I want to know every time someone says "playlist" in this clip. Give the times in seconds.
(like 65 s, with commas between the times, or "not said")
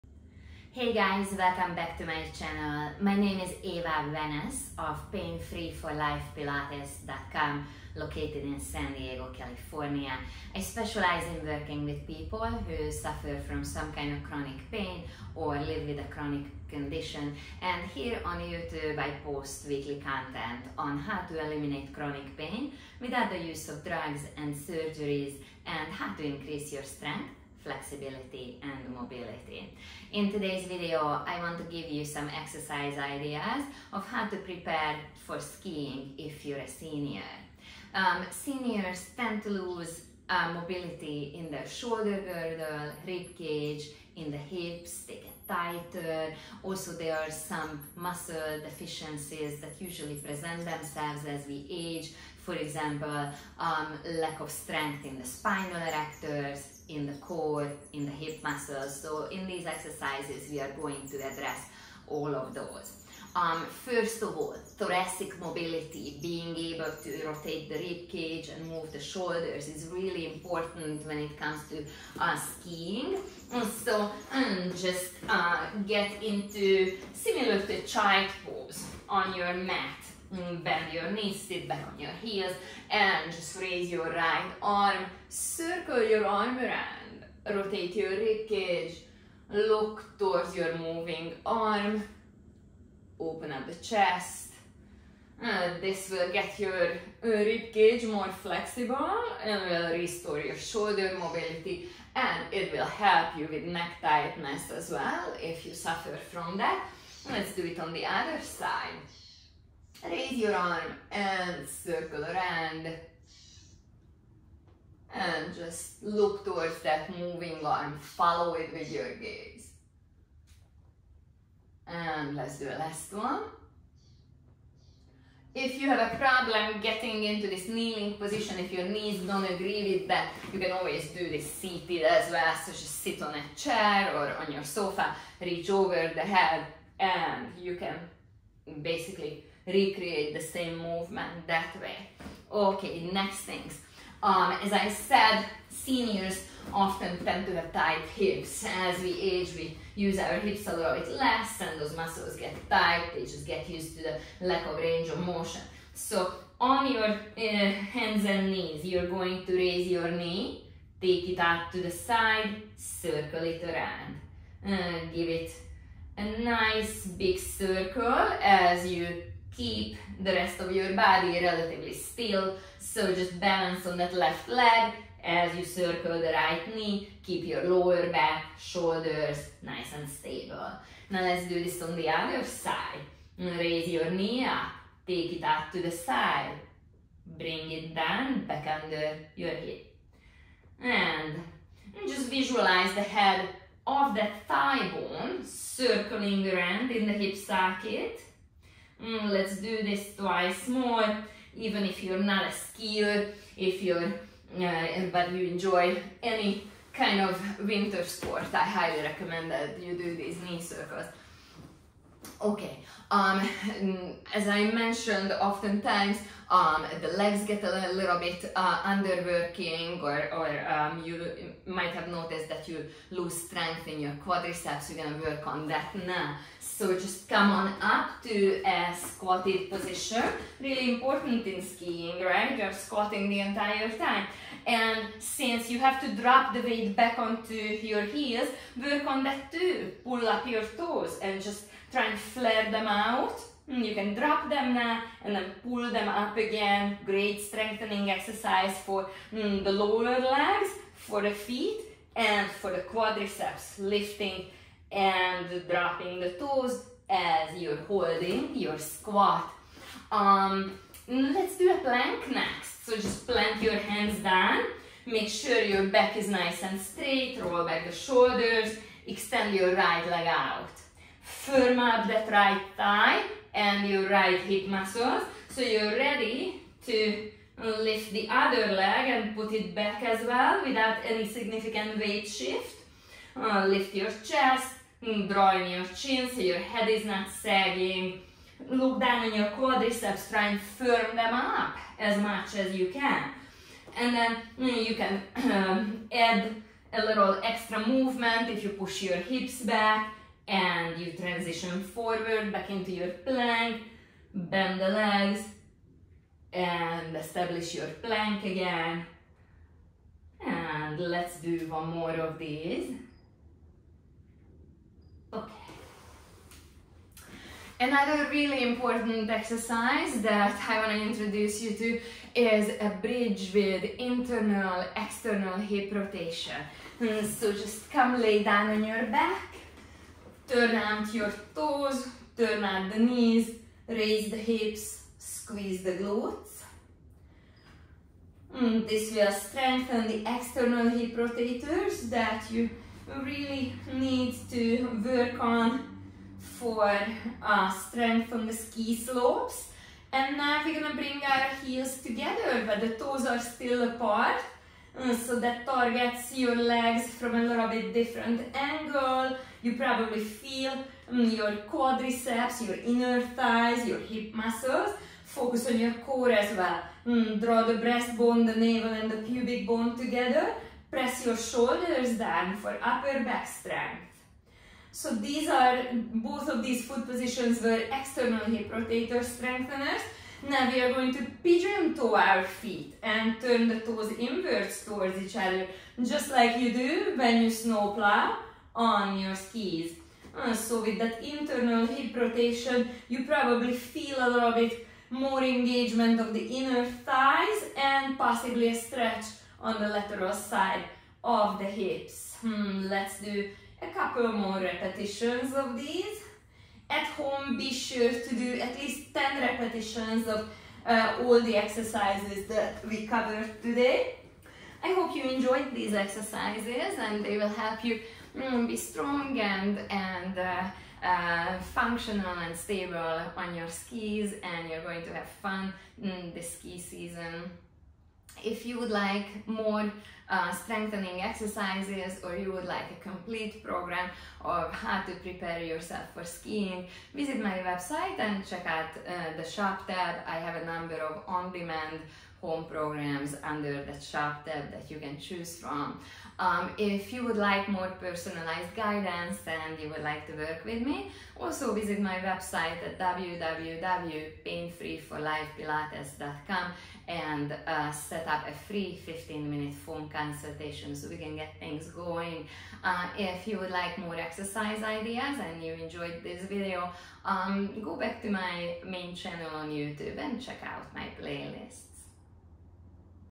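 471 s.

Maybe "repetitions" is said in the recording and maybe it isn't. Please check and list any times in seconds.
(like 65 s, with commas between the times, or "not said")
404 s, 409 s.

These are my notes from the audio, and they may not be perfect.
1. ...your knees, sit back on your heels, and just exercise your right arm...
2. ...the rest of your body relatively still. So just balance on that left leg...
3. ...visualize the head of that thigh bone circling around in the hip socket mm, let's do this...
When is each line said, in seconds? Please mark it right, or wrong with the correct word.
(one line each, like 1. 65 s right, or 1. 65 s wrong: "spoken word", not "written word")
1. 80 s wrong: "raise", not "exercise"
2. 170 s right
3. 192 s right.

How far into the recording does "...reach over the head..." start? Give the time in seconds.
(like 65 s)
135 s.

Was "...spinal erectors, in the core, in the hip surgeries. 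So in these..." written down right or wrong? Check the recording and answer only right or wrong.
wrong.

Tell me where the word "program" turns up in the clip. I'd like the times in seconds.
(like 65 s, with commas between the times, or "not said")
433 s, 442 s.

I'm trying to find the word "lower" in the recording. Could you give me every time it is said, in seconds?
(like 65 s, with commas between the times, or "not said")
177 s, 249 s.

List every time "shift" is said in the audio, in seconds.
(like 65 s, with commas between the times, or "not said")
282 s.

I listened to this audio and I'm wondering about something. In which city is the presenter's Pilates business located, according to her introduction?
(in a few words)
San Diego.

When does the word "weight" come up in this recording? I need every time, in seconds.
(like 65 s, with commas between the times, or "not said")
236 s, 281 s.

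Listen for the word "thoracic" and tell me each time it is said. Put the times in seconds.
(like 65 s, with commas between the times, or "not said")
64 s.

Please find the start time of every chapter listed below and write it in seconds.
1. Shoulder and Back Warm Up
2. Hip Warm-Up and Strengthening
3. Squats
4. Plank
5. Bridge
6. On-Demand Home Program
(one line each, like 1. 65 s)
1. 72 s
2. 149 s
3. 227 s
4. 260 s
5. 328 s
6. 419 s.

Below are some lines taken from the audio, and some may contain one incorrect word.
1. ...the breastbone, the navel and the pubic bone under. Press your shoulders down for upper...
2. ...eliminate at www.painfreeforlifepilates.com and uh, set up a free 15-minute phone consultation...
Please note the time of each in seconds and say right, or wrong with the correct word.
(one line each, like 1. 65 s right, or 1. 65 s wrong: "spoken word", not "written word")
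1. 367 s wrong: "together", not "under"
2. 452 s wrong: "website", not "eliminate".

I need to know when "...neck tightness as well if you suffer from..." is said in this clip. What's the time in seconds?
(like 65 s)
103 s.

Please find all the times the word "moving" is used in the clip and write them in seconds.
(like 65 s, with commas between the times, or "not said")
90 s, 117 s.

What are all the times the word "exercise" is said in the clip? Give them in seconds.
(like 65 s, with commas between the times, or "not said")
32 s, 59 s, 248 s, 319 s, 411 s, 415 s, 431 s, 464 s.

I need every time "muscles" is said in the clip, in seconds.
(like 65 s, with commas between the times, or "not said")
47 s, 58 s, 151 s, 274 s, 364 s.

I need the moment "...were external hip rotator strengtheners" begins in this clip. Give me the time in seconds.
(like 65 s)
377 s.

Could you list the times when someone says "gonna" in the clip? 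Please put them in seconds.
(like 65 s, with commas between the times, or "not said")
225 s, 350 s.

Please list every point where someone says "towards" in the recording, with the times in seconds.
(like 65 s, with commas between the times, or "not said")
90 s, 116 s, 384 s.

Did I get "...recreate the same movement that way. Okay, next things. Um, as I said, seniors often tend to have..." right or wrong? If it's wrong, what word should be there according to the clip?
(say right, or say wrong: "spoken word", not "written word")
right.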